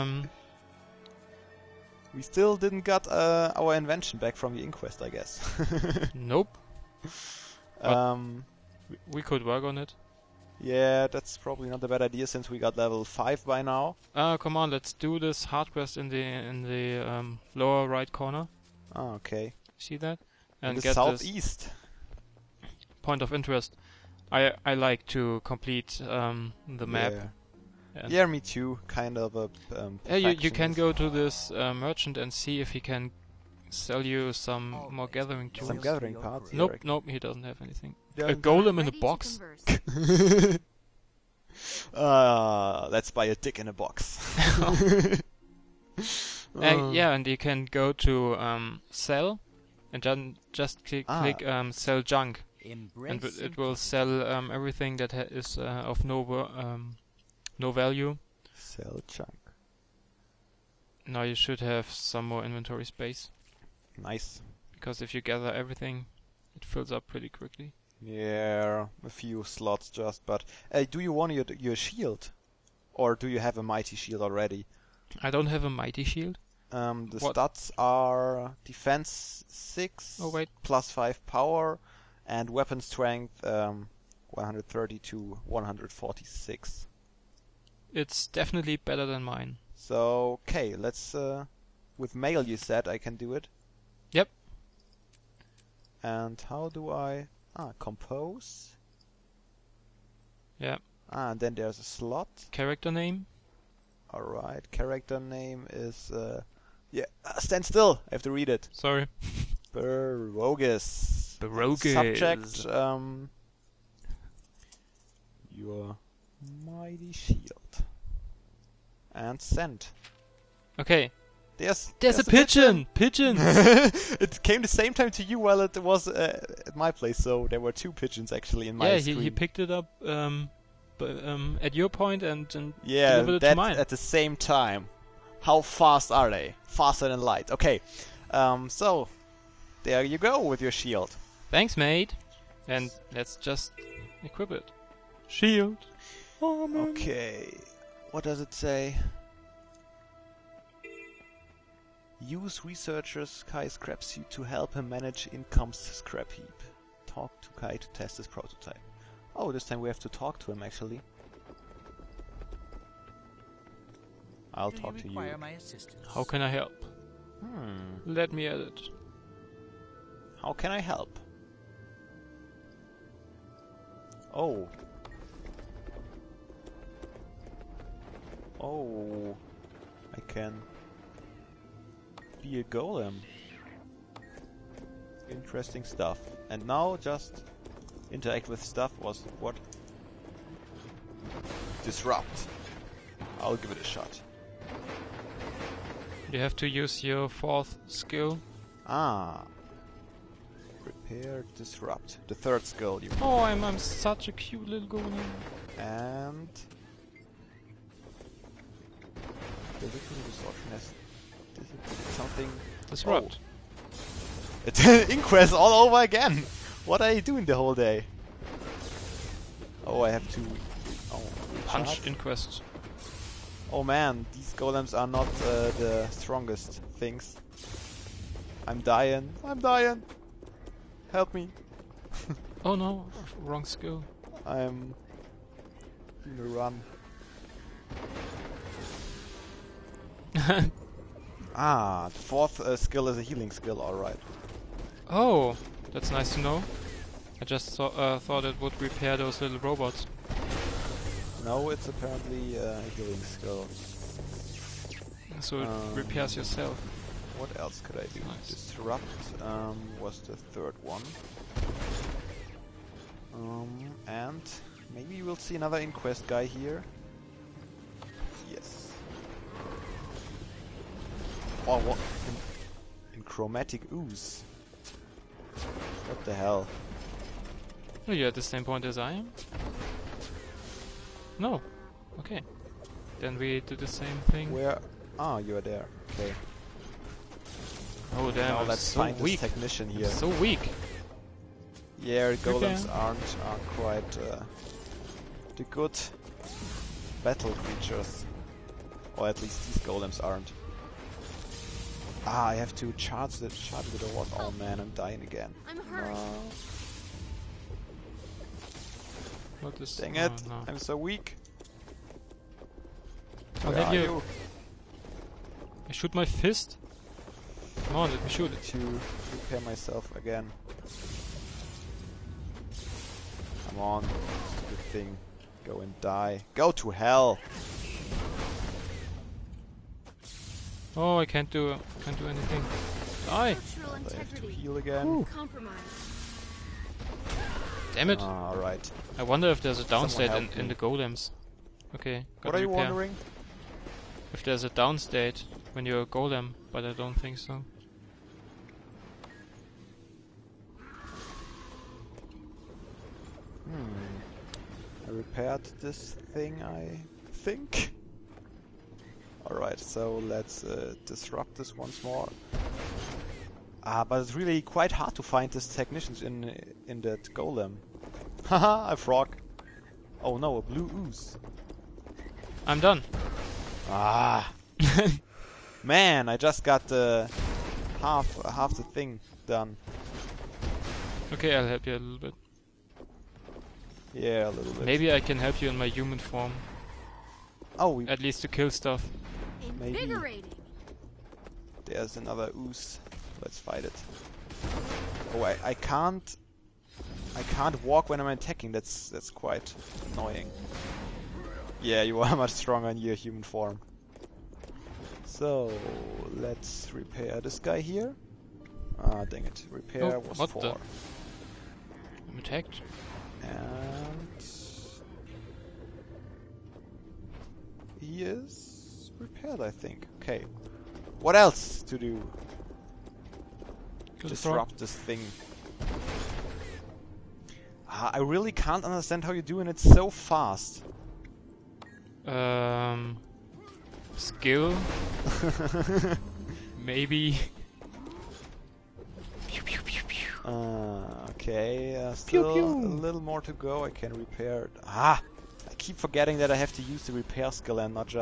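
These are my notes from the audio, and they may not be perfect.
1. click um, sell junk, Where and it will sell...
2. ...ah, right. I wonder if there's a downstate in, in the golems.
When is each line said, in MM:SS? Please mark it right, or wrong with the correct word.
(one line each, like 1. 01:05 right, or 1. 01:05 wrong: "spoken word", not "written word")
1. 00:51 wrong: "Embrace", not "Where"
2. 05:38 right.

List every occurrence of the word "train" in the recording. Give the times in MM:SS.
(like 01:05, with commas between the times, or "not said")
not said.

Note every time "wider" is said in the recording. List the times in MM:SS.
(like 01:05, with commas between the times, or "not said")
not said.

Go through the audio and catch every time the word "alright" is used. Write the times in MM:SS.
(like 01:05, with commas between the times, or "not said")
04:03, 05:59.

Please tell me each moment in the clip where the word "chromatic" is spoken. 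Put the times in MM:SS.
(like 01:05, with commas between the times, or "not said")
04:33.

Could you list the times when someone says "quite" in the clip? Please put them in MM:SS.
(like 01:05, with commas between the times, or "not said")
04:53, 06:04, 06:39.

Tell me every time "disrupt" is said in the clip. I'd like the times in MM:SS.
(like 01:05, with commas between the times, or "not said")
03:11, 03:21, 03:32, 04:18, 06:01, 07:04.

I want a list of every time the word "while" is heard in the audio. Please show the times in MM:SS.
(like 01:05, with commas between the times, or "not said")
02:05.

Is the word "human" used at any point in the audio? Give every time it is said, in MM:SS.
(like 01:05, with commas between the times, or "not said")
06:25, 06:43.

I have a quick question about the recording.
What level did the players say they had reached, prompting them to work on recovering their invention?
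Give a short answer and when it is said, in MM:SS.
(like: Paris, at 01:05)
5, at 00:12.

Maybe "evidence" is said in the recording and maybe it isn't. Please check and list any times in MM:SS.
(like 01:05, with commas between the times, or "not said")
not said.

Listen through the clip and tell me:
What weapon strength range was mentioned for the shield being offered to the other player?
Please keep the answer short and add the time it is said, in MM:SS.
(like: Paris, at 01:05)
130 to 146, at 01:24.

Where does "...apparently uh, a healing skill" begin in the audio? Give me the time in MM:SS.
04:11.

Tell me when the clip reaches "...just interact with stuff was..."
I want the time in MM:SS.
03:06.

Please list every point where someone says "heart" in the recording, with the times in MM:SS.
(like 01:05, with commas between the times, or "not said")
00:15.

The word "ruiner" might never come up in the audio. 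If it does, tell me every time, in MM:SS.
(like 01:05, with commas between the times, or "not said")
not said.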